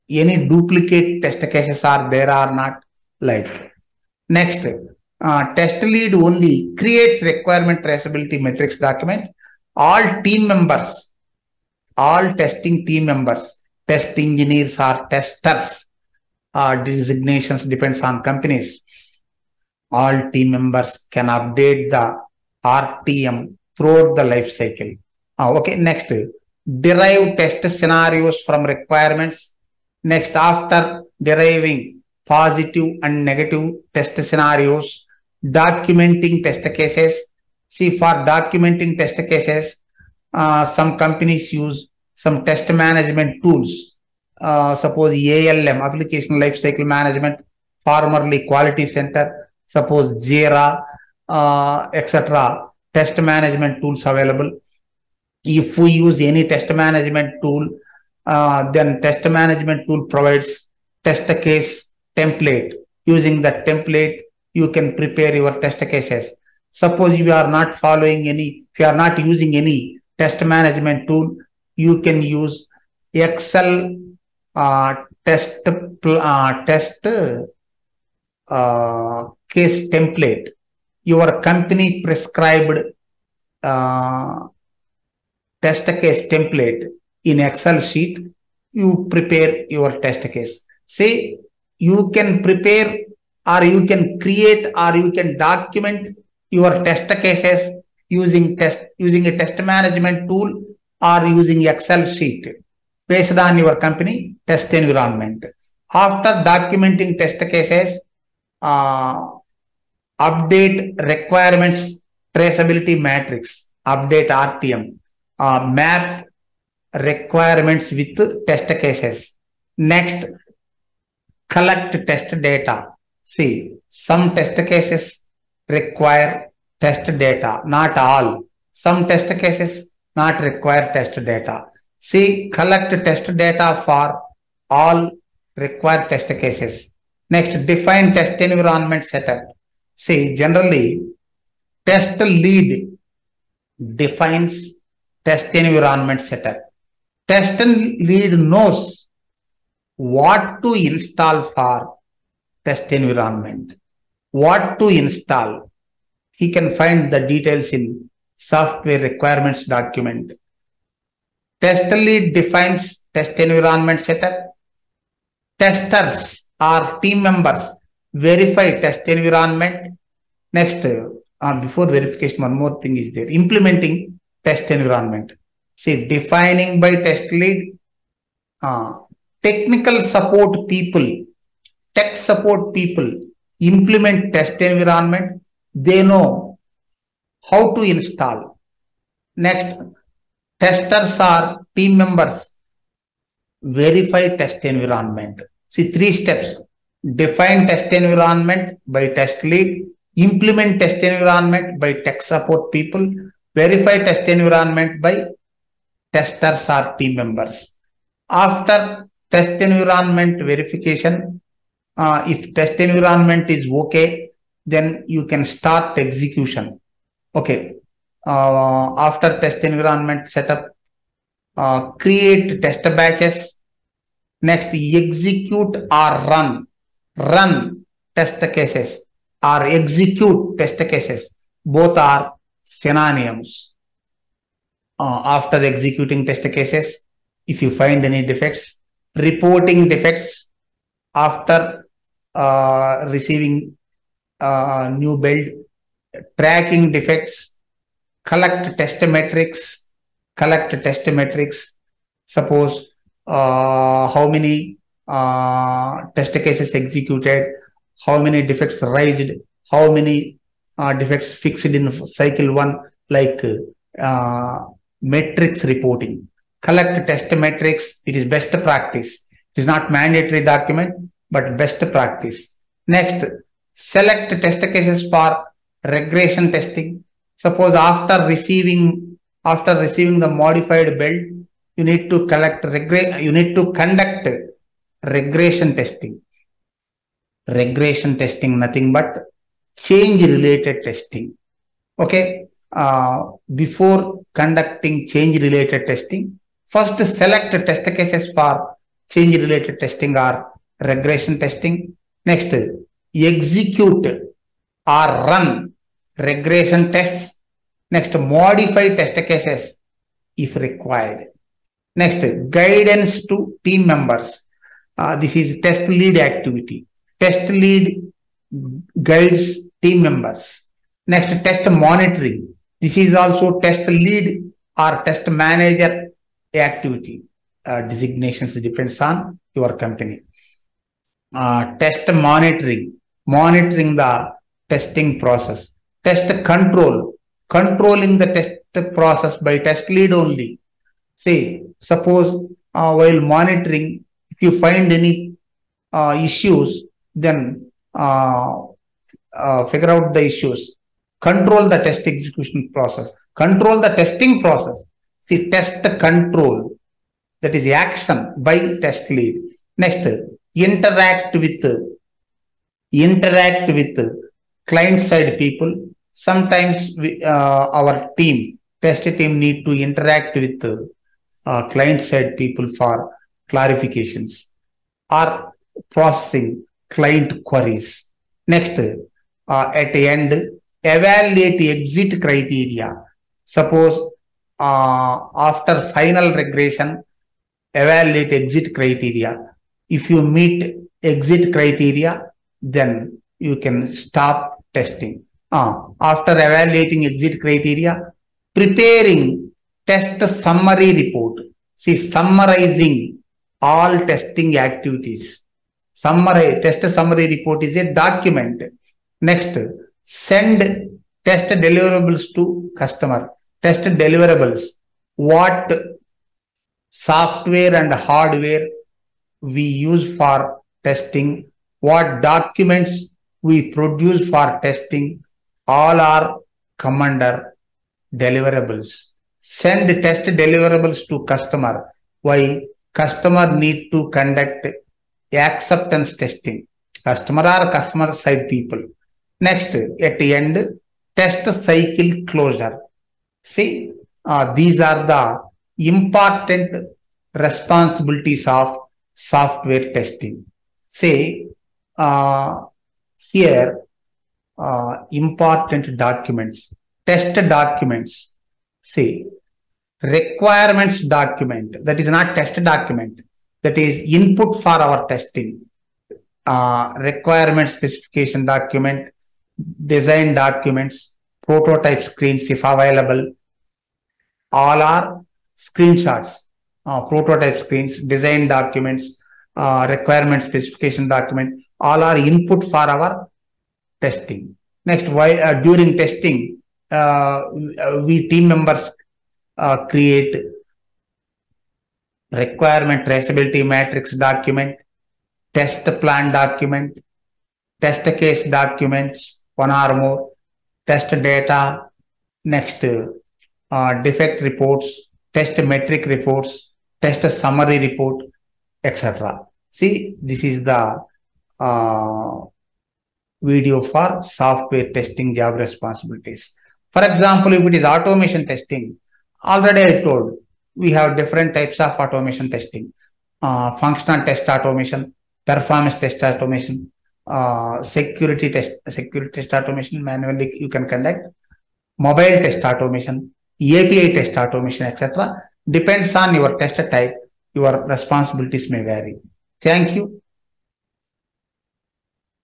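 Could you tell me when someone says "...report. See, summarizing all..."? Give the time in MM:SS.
06:40.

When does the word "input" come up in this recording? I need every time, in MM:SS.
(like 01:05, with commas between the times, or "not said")
07:44, 08:02.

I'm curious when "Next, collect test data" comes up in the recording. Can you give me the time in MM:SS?
01:59.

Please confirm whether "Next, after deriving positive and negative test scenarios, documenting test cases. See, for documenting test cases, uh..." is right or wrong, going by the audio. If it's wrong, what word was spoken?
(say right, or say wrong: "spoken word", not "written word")
right.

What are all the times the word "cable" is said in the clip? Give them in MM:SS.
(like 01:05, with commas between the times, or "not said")
not said.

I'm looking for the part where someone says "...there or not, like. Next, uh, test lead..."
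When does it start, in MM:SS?
00:02.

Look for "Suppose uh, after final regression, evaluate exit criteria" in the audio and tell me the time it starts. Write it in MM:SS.
06:23.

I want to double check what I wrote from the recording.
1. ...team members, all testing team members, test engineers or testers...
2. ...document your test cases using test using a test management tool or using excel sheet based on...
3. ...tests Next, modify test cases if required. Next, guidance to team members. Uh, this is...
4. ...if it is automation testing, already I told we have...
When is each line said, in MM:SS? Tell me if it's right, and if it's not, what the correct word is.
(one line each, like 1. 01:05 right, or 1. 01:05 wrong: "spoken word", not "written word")
1. 00:10 right
2. 01:35 right
3. 05:06 right
4. 08:37 right.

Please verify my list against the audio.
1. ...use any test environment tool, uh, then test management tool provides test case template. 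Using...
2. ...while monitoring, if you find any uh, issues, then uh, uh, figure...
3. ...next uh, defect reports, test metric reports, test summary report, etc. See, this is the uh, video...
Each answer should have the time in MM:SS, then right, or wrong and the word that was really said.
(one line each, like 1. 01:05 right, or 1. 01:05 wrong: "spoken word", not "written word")
1. 00:55 wrong: "management", not "environment"
2. 05:42 right
3. 08:22 right.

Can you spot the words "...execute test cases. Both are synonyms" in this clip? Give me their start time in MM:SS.
03:49.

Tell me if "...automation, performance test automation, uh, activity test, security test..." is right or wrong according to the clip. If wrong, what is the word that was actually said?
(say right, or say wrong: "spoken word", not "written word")
wrong: "security", not "activity".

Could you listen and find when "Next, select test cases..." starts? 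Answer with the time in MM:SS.
04:32.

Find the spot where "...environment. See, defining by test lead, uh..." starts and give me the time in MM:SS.
02:54.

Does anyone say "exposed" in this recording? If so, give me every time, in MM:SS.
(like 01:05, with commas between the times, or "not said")
not said.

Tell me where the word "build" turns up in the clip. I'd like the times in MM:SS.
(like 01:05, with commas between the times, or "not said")
04:05, 04:40.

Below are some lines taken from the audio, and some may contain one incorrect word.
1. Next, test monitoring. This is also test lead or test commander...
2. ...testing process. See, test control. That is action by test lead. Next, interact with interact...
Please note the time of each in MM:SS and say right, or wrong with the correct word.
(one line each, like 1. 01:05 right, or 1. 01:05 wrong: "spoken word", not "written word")
1. 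05:21 wrong: "manager", not "commander"
2. 05:53 right.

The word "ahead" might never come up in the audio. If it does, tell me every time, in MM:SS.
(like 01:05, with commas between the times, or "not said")
not said.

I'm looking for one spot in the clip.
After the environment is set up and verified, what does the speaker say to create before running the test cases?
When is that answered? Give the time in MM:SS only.
03:42.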